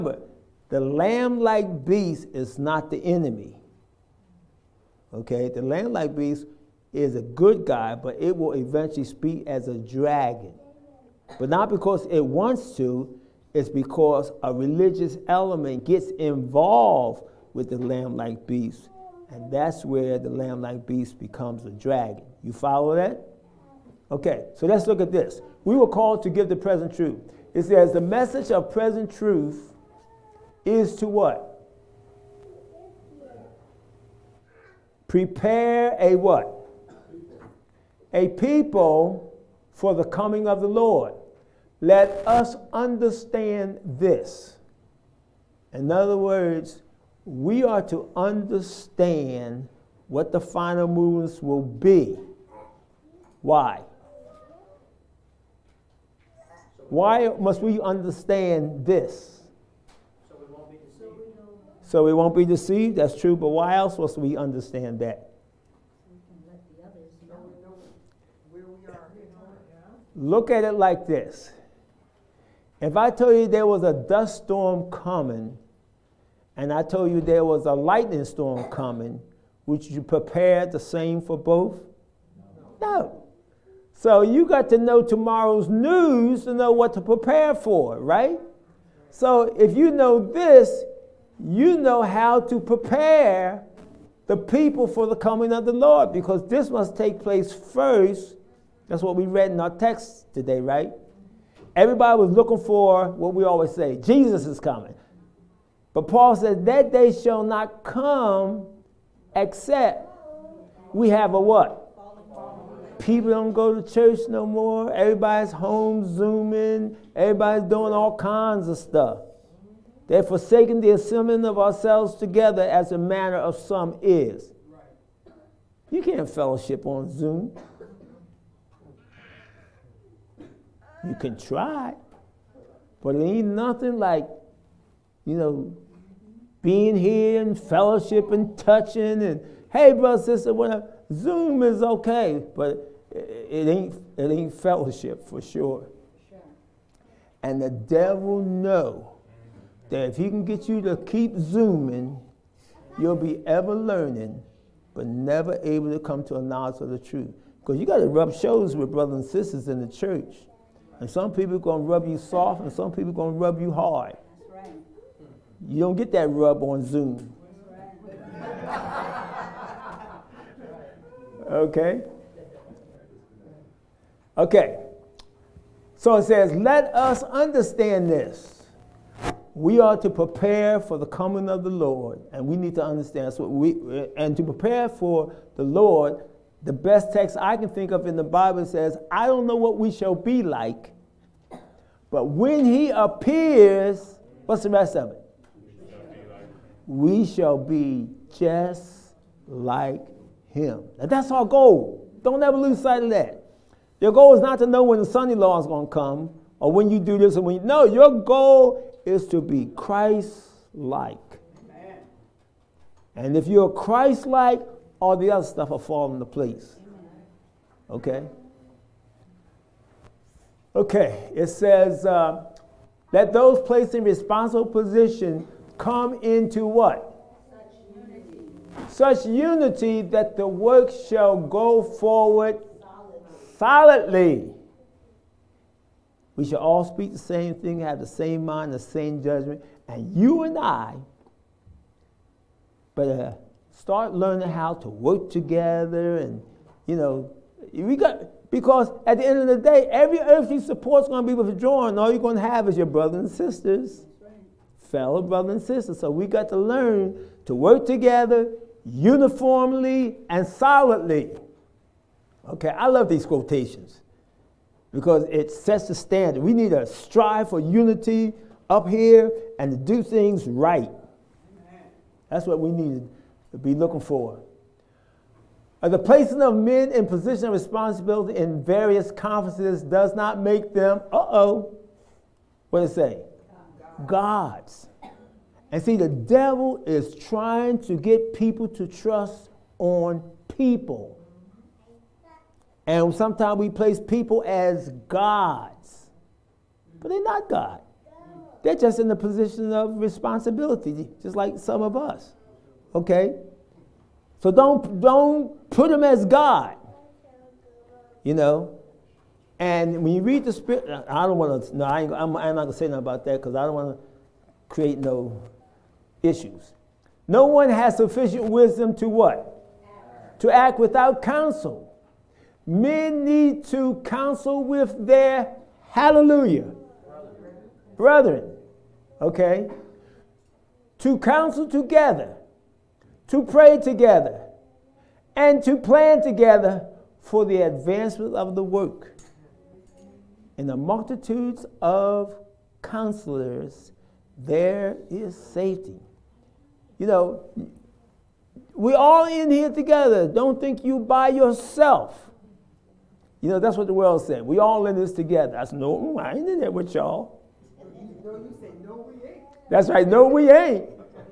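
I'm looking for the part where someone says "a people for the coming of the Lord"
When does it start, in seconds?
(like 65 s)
38 s.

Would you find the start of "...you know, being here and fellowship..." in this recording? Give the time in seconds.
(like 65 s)
135 s.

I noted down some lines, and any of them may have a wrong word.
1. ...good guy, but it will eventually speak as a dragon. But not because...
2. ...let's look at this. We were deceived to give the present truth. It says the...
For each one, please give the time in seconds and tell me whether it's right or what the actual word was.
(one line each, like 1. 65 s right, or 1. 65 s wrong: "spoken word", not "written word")
1. 7 s right
2. 24 s wrong: "called", not "deceived".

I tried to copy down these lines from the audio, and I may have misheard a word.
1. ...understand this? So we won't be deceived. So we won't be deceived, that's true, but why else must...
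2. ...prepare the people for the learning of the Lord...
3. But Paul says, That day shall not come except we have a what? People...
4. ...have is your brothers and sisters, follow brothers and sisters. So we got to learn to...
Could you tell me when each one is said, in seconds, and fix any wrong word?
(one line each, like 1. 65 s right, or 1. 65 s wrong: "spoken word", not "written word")
1. 57 s right
2. 92 s wrong: "coming", not "learning"
3. 105 s right
4. 252 s wrong: "fellow", not "follow".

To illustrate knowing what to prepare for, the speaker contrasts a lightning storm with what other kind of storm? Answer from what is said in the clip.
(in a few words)
dust storm.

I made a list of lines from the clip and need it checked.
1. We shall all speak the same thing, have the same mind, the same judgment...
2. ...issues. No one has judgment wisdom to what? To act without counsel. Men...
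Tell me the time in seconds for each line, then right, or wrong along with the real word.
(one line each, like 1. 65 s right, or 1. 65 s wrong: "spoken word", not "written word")
1. 236 s right
2. 316 s wrong: "sufficient", not "judgment".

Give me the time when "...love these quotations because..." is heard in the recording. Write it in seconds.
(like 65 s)
262 s.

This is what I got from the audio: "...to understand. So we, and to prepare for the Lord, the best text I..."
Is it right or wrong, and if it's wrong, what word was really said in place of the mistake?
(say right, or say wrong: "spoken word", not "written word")
right.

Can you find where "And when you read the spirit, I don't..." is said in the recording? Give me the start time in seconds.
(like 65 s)
309 s.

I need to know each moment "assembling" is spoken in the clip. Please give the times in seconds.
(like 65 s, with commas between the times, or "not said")
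120 s.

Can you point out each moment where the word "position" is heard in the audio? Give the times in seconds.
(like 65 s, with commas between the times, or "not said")
224 s, 277 s, 299 s.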